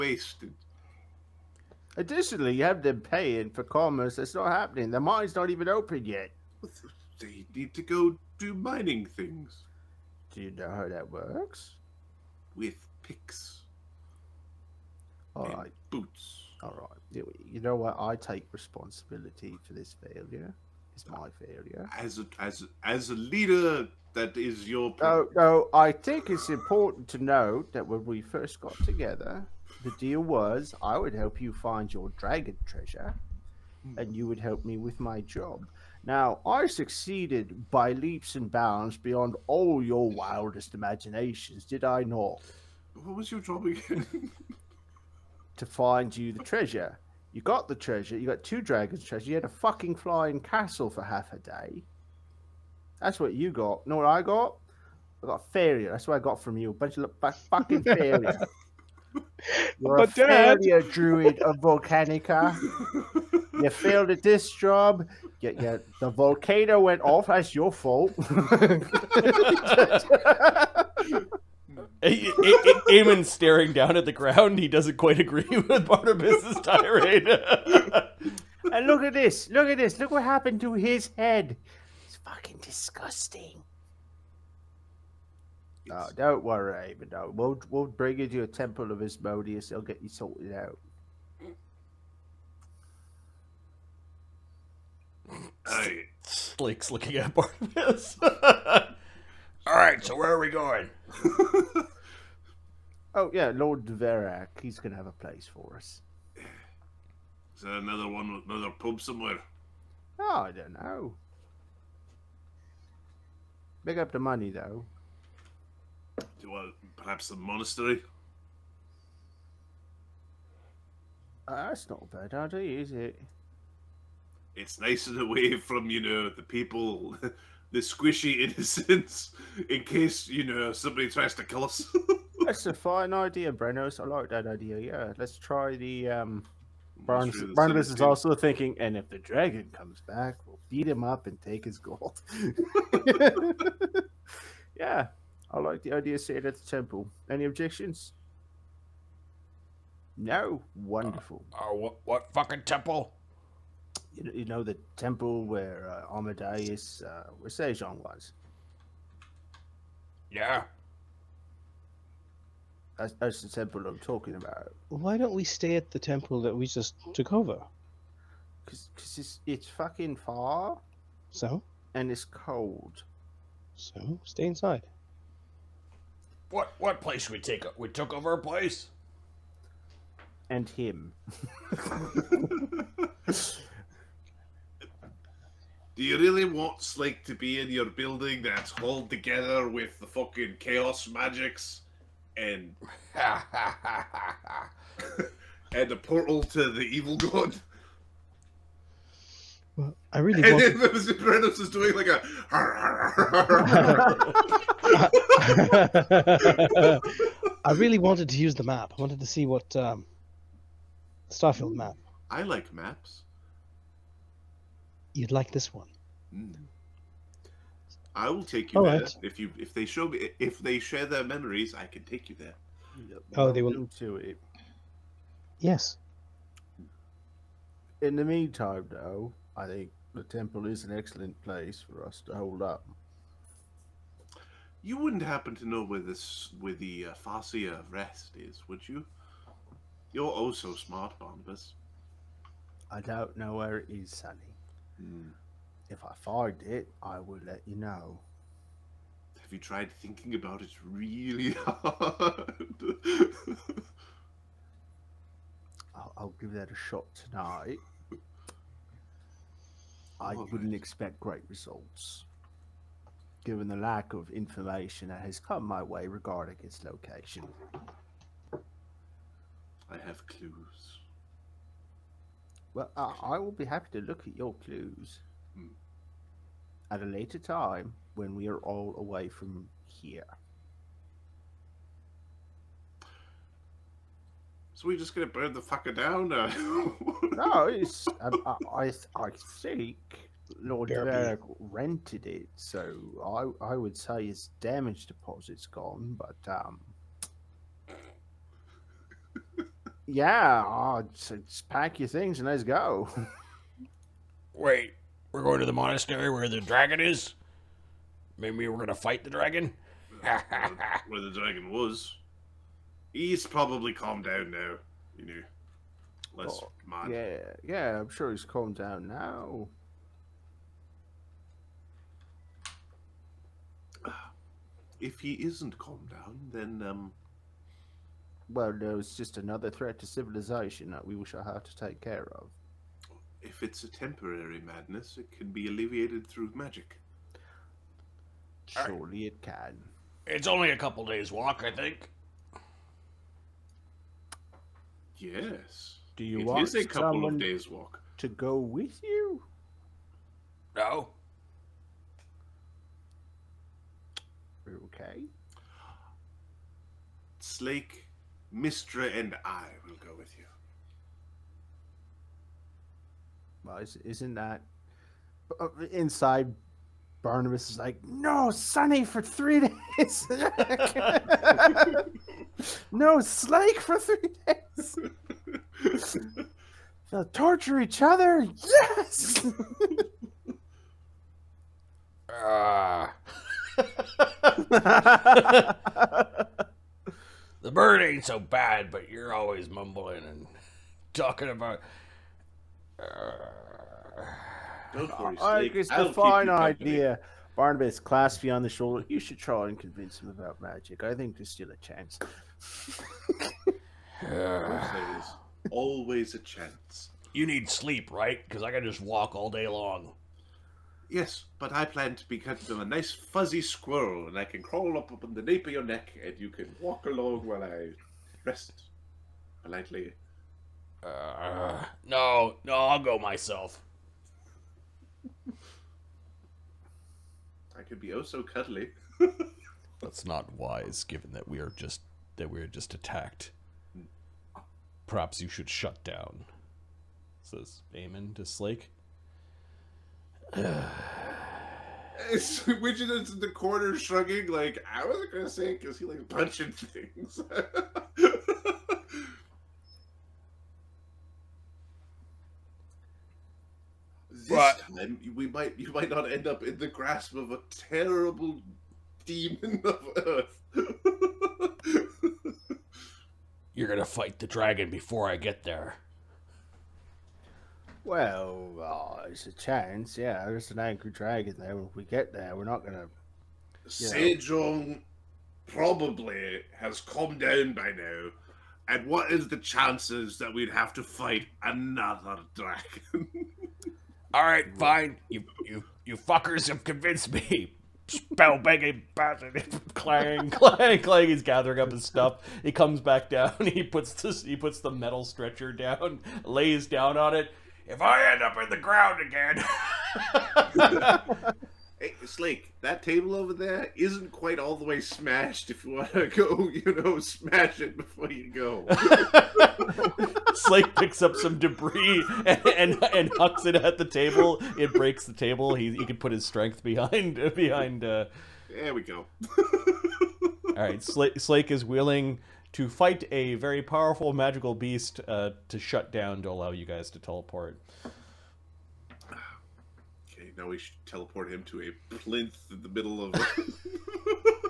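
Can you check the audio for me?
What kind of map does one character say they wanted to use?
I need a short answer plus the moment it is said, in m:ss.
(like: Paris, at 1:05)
Starfield map, at 3:31.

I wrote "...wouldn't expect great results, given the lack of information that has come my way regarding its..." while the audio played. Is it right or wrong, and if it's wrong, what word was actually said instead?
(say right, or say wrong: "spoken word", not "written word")
right.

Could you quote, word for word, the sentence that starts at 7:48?
Well, there's uh, it's a chance.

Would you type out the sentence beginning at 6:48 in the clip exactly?
Because I can just walk all day long.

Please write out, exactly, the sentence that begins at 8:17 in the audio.
If I end up in the ground again.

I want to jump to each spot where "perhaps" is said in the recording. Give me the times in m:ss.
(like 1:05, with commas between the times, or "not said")
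1:56, 7:15.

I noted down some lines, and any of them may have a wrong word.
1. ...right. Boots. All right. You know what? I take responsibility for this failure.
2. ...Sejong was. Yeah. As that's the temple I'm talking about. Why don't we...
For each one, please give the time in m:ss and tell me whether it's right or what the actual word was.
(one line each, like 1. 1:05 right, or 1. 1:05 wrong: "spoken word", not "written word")
1. 0:15 right
2. 2:37 right.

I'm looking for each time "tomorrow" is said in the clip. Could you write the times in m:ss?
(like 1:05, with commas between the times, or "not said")
not said.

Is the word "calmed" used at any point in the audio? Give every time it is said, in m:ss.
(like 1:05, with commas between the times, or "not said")
5:13, 5:18, 5:25, 7:56.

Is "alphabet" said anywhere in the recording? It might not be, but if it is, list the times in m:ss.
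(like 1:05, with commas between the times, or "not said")
not said.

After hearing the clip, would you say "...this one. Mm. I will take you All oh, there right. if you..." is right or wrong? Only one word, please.
right.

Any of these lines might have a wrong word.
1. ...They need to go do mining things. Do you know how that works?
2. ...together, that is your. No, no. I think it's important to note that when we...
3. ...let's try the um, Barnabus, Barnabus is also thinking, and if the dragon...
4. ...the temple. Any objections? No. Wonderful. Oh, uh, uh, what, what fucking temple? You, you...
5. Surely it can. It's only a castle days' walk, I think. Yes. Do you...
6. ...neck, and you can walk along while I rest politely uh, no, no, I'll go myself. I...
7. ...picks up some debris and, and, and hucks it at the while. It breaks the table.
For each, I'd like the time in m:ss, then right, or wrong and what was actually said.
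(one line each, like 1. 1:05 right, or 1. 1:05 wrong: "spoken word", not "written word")
1. 0:07 right
2. 0:23 wrong: "leader", not "together"
3. 2:15 right
4. 2:26 right
5. 5:38 wrong: "couple", not "castle"
6. 6:55 right
7. 8:30 wrong: "table", not "while".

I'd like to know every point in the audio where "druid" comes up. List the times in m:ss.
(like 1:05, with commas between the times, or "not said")
1:00.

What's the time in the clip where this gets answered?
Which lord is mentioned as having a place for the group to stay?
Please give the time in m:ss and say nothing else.
1:43.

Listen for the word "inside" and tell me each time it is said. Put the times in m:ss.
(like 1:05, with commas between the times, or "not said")
2:54, 6:05.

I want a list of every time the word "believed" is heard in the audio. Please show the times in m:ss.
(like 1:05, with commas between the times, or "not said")
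not said.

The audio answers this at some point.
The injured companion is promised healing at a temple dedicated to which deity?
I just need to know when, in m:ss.
1:29.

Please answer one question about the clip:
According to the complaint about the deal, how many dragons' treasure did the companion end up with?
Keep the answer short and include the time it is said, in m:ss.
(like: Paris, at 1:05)
two, at 0:48.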